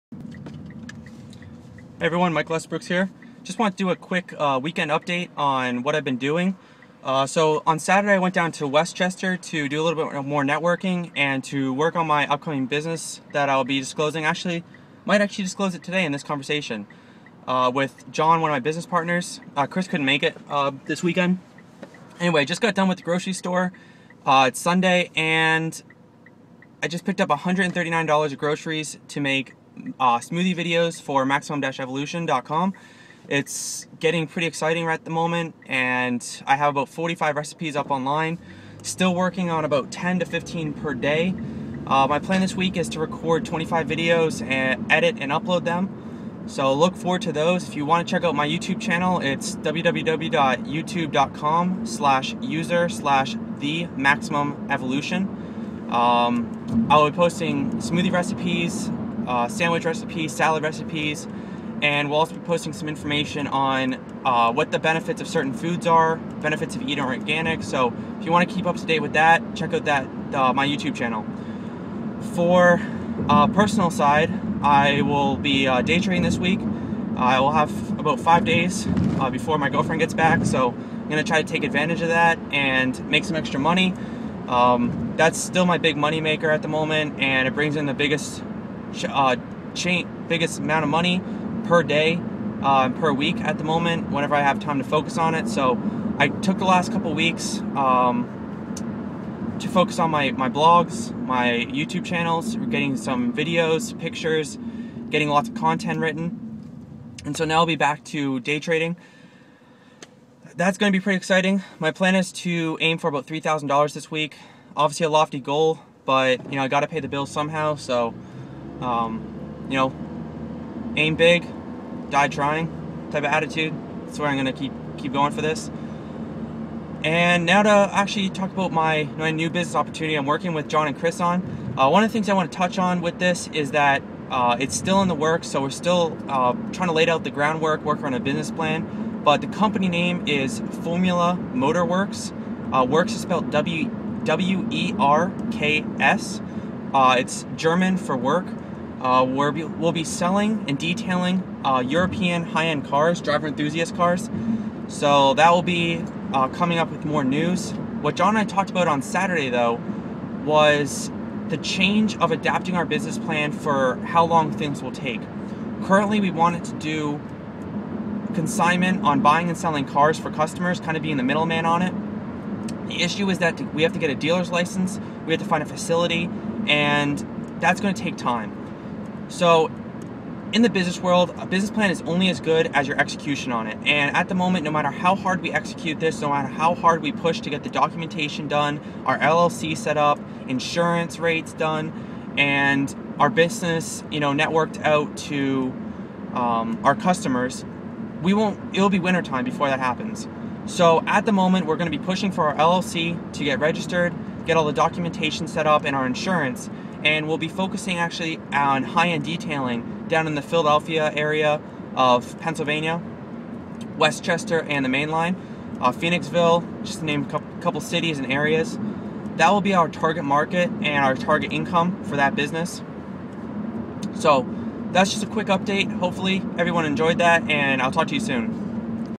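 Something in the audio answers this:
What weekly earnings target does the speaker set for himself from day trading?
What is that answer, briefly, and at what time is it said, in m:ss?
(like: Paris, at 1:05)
$3,000, at 1:53.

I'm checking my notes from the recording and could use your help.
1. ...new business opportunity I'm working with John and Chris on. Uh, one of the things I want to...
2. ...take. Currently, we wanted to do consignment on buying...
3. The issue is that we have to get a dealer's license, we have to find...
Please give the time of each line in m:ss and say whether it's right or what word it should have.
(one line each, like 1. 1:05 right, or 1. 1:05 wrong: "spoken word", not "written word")
1. 2:09 right
2. 2:44 right
3. 2:52 right.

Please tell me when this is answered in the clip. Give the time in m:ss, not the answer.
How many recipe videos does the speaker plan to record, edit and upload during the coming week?
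0:43.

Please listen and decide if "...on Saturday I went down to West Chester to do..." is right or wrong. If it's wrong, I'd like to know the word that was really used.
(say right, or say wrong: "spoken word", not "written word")
right.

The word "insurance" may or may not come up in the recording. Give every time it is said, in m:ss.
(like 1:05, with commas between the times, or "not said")
3:10, 3:26.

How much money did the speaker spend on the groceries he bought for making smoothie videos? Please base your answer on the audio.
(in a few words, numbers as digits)
$139.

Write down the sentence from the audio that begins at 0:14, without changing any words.
Actually, might actually disclose it today in this conversation uh, with John, one of my business partners.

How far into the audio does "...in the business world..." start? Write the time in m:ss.
3:00.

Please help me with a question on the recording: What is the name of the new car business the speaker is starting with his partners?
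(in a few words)
Formula Motor Werks.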